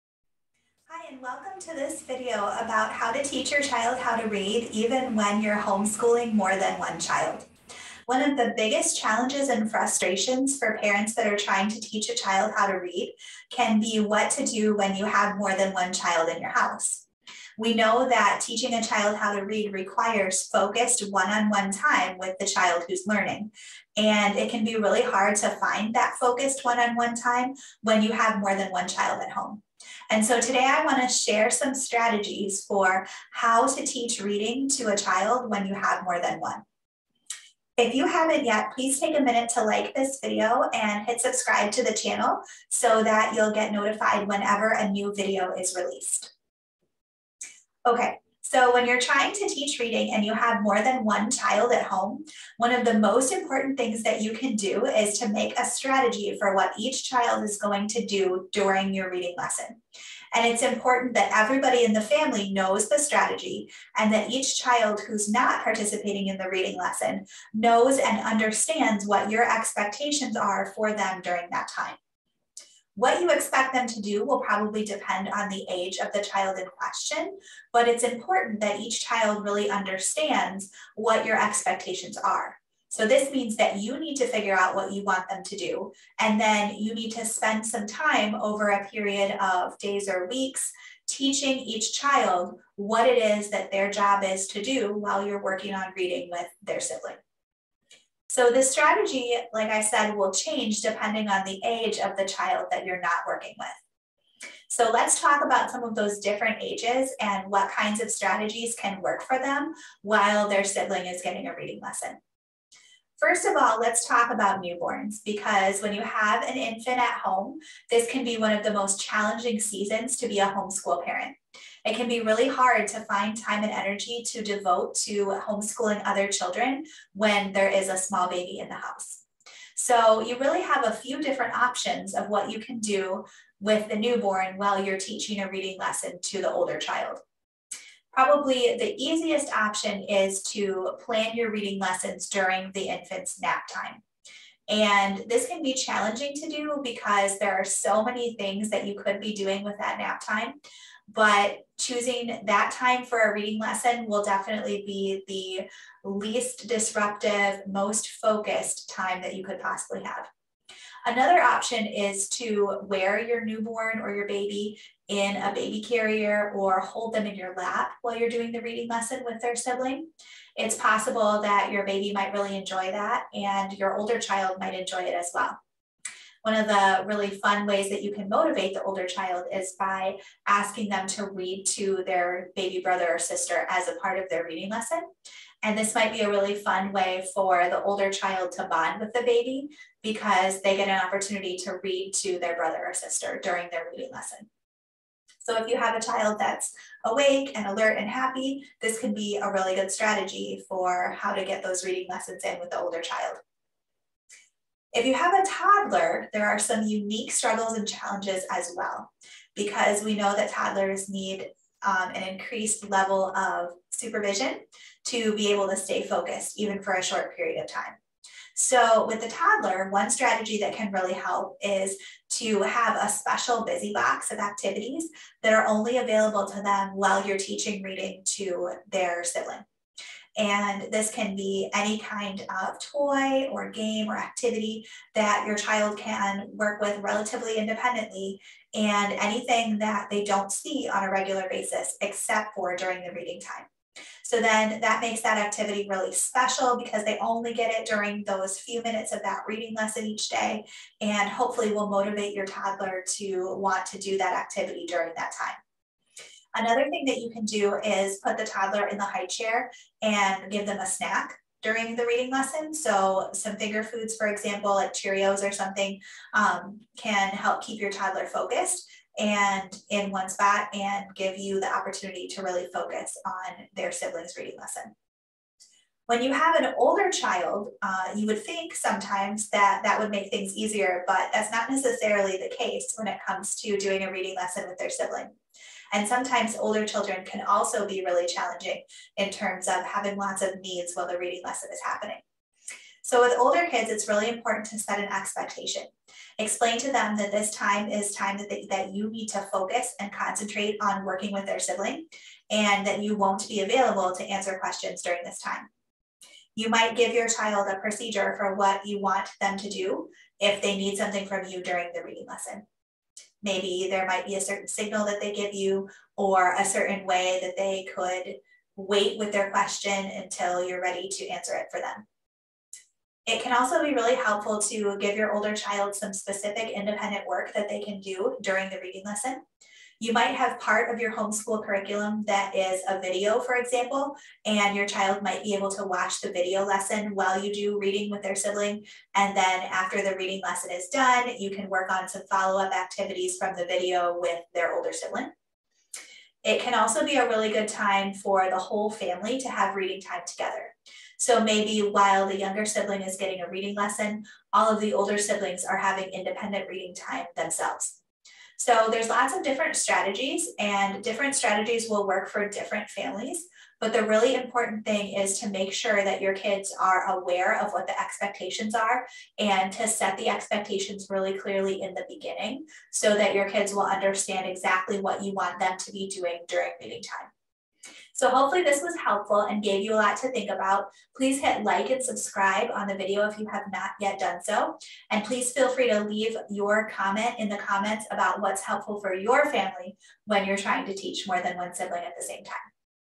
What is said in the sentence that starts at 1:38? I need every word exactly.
So this strategy, like I said, will change depending on the age of the child that you're not working with.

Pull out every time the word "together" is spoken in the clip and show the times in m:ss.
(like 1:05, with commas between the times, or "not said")
5:50.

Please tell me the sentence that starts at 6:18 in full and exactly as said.
So hopefully this was helpful and gave you a lot to think about.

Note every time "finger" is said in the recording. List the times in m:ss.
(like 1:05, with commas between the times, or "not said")
4:23.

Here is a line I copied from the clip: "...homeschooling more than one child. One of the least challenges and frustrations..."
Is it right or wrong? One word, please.
wrong.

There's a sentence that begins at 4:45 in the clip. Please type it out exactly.
And sometimes older children can also be really challenging in terms of having lots of needs while the reading lesson is happening.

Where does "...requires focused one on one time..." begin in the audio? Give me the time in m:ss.
0:19.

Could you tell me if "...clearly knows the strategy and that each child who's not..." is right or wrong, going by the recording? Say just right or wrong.
wrong.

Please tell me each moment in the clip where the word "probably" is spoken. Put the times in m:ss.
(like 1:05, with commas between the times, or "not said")
1:14, 2:18.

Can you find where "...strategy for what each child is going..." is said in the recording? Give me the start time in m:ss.
0:55.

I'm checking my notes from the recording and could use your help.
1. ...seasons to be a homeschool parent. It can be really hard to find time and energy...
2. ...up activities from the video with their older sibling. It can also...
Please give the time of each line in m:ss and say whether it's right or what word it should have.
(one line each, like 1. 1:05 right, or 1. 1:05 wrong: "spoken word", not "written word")
1. 1:59 right
2. 5:42 right.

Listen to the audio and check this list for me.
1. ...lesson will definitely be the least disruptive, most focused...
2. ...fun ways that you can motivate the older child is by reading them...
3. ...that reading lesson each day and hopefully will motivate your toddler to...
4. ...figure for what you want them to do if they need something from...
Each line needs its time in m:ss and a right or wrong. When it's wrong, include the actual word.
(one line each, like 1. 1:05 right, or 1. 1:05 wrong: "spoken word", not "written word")
1. 2:33 right
2. 2:57 wrong: "asking", not "reading"
3. 4:09 right
4. 5:07 wrong: "procedure", not "figure".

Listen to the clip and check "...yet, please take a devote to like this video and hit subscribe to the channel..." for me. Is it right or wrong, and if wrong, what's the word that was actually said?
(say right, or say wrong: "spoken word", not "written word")
wrong: "minute", not "devote".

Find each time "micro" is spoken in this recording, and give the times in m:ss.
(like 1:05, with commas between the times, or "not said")
not said.